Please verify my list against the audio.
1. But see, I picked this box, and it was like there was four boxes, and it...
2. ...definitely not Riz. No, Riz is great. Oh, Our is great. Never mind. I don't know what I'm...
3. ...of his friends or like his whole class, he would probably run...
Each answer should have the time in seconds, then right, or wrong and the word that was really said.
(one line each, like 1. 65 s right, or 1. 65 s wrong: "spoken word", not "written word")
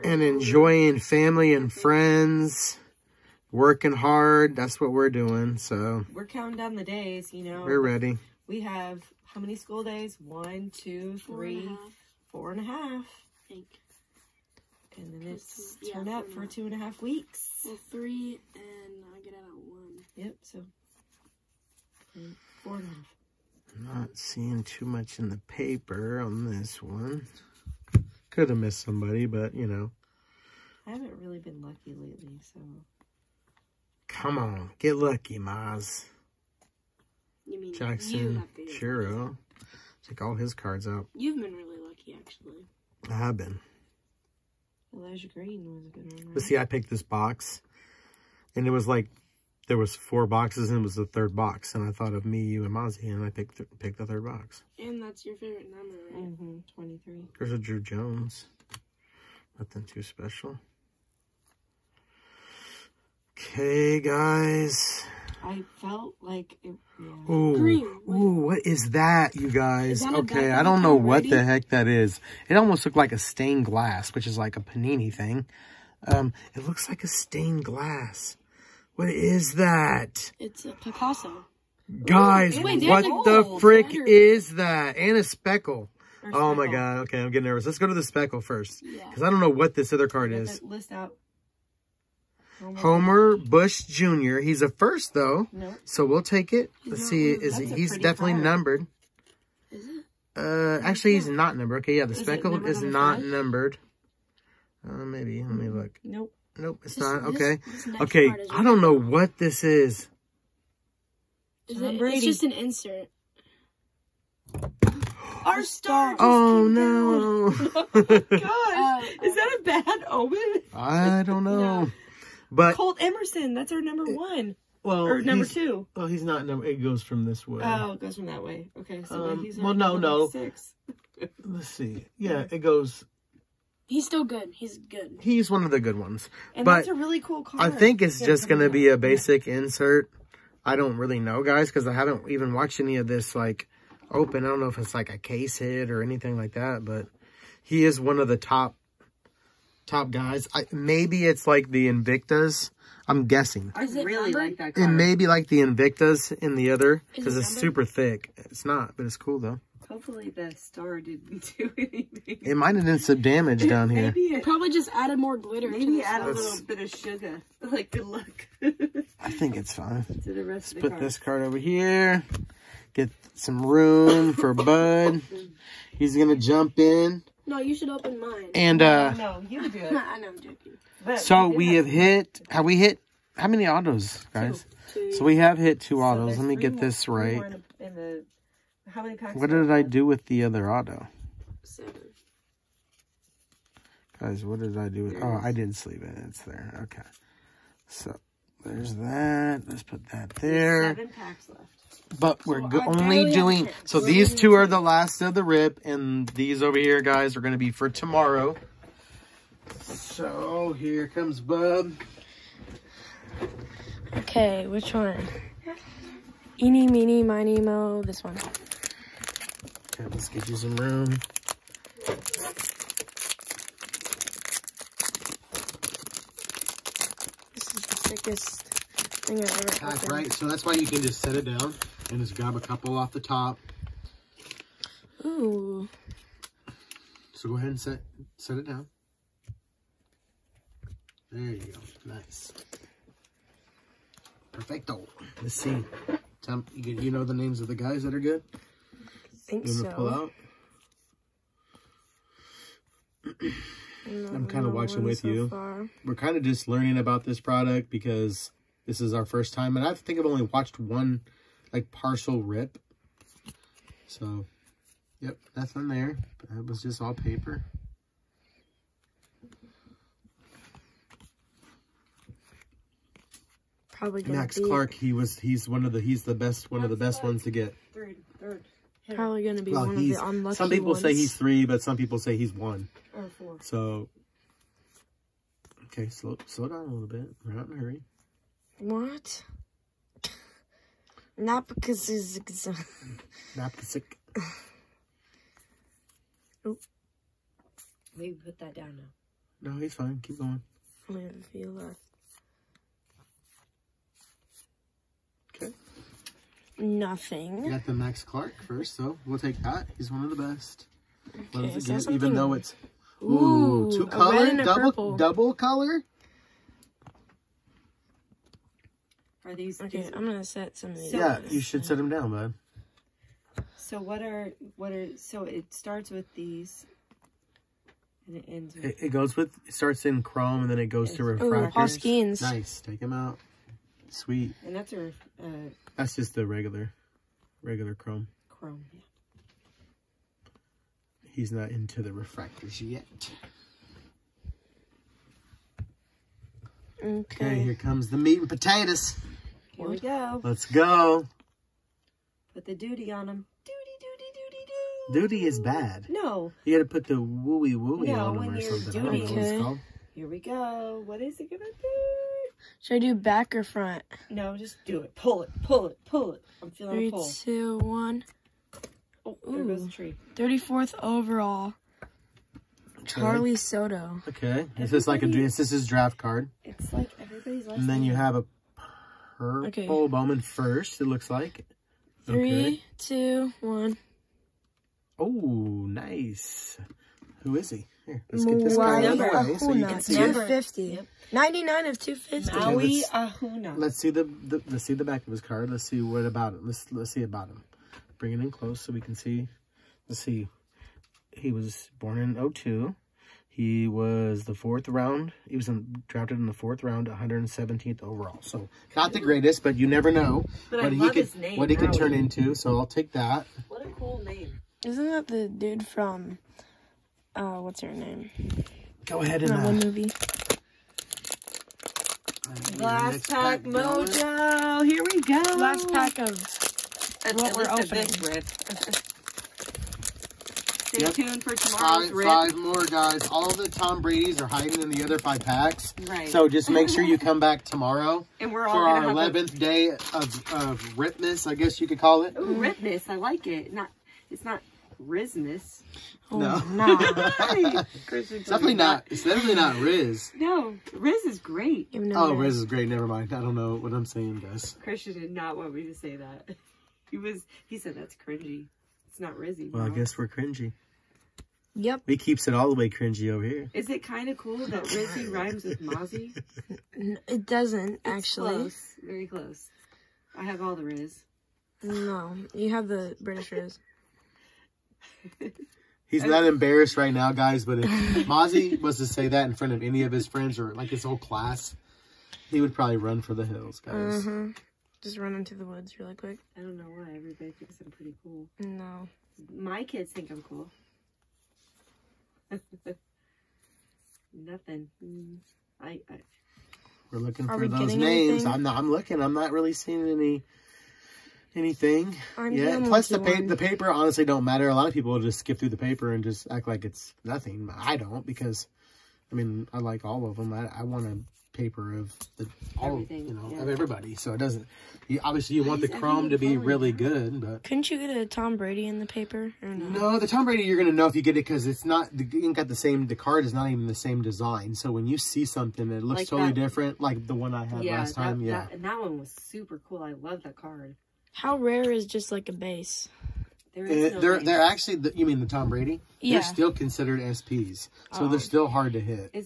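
1. 46 s right
2. 449 s wrong: "Riz", not "Our"
3. 480 s right.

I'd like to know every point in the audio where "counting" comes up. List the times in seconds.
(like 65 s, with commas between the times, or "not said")
6 s.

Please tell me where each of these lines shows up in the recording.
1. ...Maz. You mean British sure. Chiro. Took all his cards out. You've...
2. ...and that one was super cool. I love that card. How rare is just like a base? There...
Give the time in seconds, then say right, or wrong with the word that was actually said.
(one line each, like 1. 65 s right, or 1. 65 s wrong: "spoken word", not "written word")
1. 35 s wrong: "Jackson", not "British"
2. 528 s right.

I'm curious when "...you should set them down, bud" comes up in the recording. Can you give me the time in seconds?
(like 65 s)
321 s.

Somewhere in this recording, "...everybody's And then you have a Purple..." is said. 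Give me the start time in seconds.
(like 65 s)
377 s.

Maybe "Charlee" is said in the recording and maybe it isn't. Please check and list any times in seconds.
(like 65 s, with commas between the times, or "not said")
373 s.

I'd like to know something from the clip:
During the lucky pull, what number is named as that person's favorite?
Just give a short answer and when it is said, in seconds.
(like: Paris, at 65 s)
23, at 56 s.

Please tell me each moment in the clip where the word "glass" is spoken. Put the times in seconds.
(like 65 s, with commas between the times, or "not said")
73 s, 77 s.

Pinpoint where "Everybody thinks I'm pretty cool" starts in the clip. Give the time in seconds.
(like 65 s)
487 s.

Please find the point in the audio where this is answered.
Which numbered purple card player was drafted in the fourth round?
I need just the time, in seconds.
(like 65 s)
392 s.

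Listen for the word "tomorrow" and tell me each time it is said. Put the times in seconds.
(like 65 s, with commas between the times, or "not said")
207 s, 431 s, 437 s.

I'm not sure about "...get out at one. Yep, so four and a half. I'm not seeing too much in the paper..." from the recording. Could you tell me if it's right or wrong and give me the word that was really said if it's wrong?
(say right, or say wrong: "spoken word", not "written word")
right.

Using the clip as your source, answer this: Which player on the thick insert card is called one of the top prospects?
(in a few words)
Colt Emerson.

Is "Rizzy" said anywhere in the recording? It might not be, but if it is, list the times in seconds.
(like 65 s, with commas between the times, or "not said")
459 s, 464 s.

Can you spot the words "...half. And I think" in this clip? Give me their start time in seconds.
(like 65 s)
12 s.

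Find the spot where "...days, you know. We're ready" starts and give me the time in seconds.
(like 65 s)
6 s.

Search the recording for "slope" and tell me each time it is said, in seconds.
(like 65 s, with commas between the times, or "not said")
not said.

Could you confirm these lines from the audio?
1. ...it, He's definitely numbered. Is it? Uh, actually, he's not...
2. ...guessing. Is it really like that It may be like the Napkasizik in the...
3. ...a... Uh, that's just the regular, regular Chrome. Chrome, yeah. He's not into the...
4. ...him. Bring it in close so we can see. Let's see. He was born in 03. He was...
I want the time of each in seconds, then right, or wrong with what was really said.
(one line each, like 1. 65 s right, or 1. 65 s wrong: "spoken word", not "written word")
1. 97 s right
2. 153 s wrong: "Invictas", not "Napkasizik"
3. 334 s right
4. 397 s wrong: "02", not "03".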